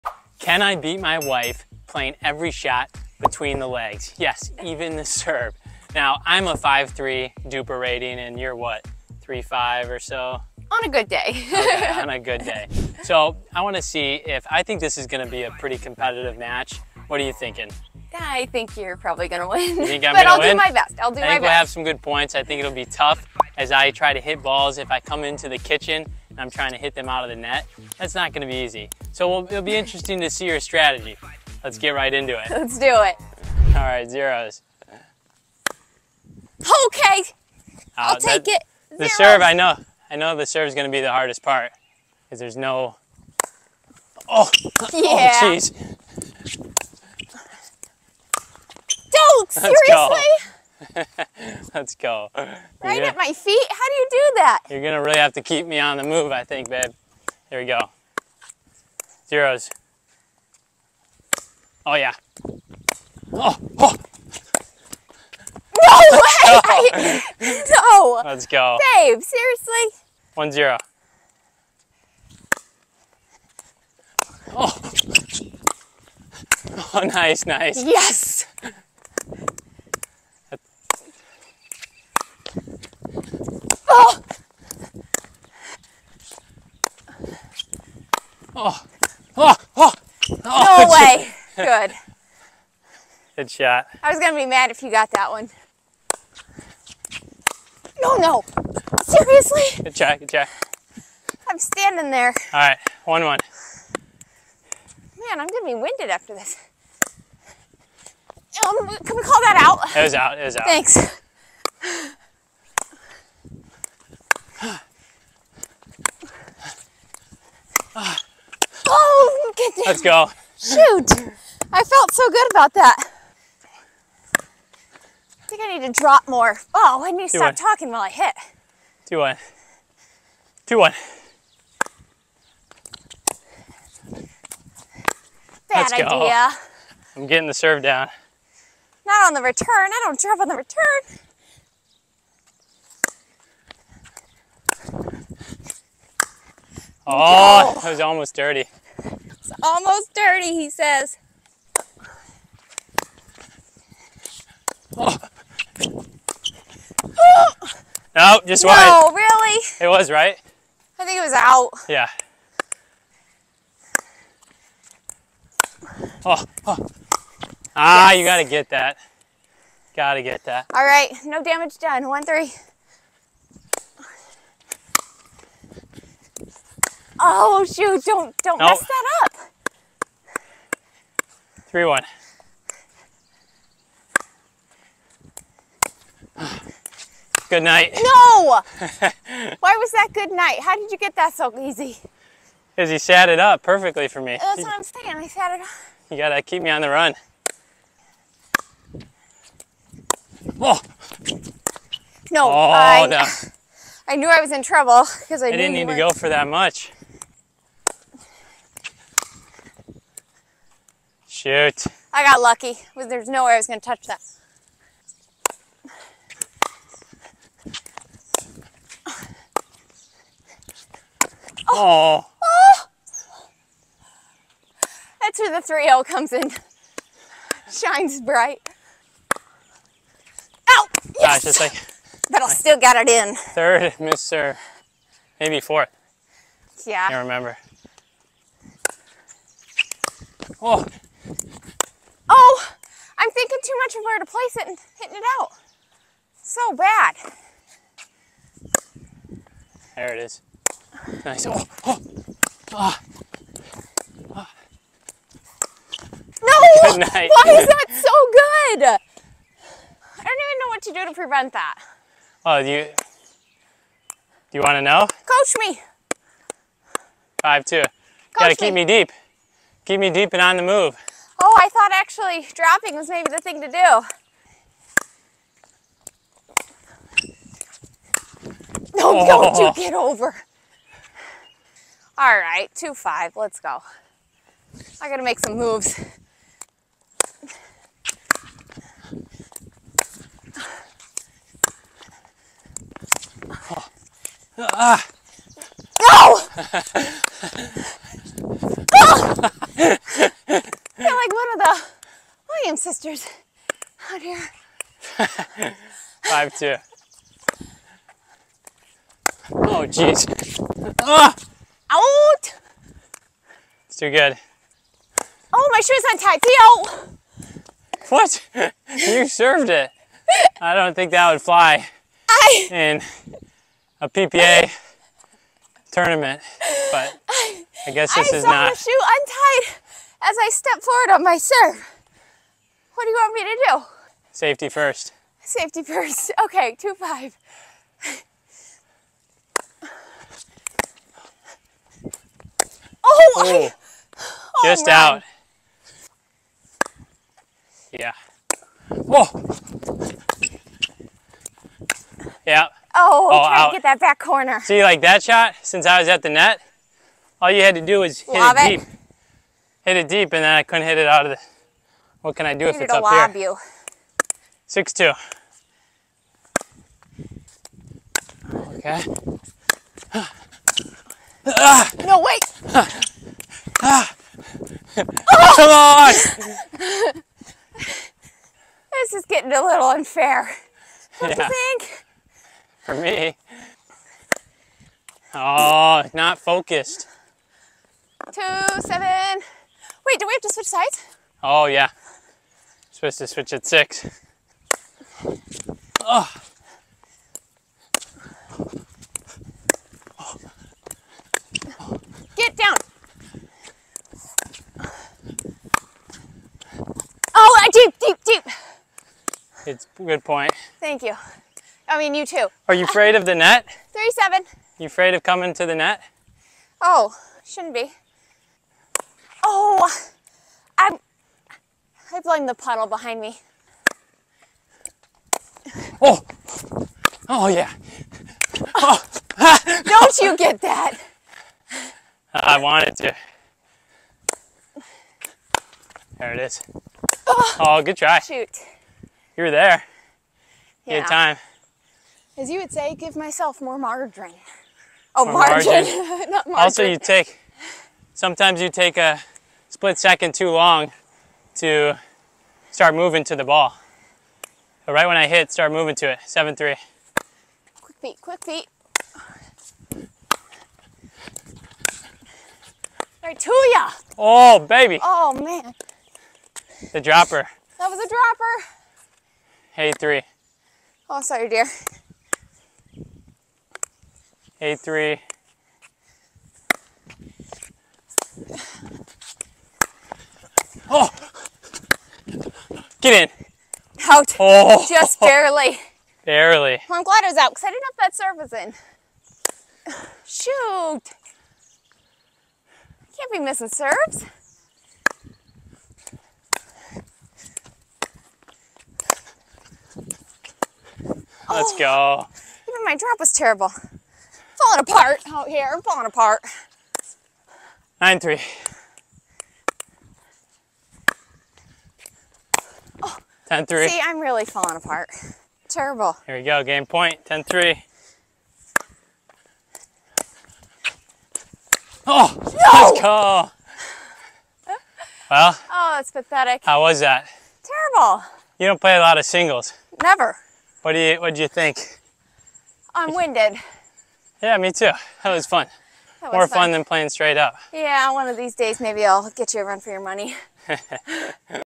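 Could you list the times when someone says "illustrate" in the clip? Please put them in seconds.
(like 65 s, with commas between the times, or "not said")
not said.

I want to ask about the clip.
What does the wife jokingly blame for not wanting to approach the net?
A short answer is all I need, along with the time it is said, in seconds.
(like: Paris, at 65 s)
The puddle, at 422 s.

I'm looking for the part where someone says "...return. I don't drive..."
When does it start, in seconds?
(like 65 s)
139 s.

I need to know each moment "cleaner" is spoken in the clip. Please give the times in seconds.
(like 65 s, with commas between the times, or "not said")
not said.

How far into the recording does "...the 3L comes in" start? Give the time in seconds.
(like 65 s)
225 s.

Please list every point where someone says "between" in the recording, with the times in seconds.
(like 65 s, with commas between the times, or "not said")
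3 s.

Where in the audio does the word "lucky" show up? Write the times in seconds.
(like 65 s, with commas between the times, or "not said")
212 s.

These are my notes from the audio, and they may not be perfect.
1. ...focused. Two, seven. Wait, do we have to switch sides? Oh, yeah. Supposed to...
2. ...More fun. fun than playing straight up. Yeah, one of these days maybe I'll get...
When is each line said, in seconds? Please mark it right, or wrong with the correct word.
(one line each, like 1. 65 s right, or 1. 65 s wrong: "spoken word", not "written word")
1. 386 s right
2. 536 s right.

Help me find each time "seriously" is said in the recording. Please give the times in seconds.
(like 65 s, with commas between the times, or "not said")
49 s, 69 s, 99 s.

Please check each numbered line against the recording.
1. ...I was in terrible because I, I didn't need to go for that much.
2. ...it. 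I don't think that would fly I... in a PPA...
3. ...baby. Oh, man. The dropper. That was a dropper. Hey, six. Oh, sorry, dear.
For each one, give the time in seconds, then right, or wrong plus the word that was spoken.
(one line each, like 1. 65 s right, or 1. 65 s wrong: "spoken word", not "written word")
1. 204 s wrong: "trouble", not "terrible"
2. 319 s right
3. 464 s wrong: "three", not "six".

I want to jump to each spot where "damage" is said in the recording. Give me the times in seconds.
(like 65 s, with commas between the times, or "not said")
171 s.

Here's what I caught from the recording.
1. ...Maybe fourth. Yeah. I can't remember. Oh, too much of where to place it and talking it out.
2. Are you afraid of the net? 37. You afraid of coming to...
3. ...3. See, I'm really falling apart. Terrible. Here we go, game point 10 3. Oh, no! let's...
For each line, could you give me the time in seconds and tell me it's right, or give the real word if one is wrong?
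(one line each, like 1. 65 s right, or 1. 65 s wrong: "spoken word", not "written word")
1. 235 s wrong: "hitting", not "talking"
2. 412 s right
3. 513 s right.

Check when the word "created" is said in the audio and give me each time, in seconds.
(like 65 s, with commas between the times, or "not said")
not said.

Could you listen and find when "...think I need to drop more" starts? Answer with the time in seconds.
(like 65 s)
125 s.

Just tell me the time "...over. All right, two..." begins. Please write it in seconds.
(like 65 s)
279 s.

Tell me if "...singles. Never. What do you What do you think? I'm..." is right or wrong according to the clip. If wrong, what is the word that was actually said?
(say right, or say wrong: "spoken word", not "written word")
right.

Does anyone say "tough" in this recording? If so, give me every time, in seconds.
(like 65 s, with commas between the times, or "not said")
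22 s.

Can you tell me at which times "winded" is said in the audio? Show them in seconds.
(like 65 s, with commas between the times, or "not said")
105 s, 533 s.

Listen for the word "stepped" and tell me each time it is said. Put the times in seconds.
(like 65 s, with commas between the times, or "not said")
330 s.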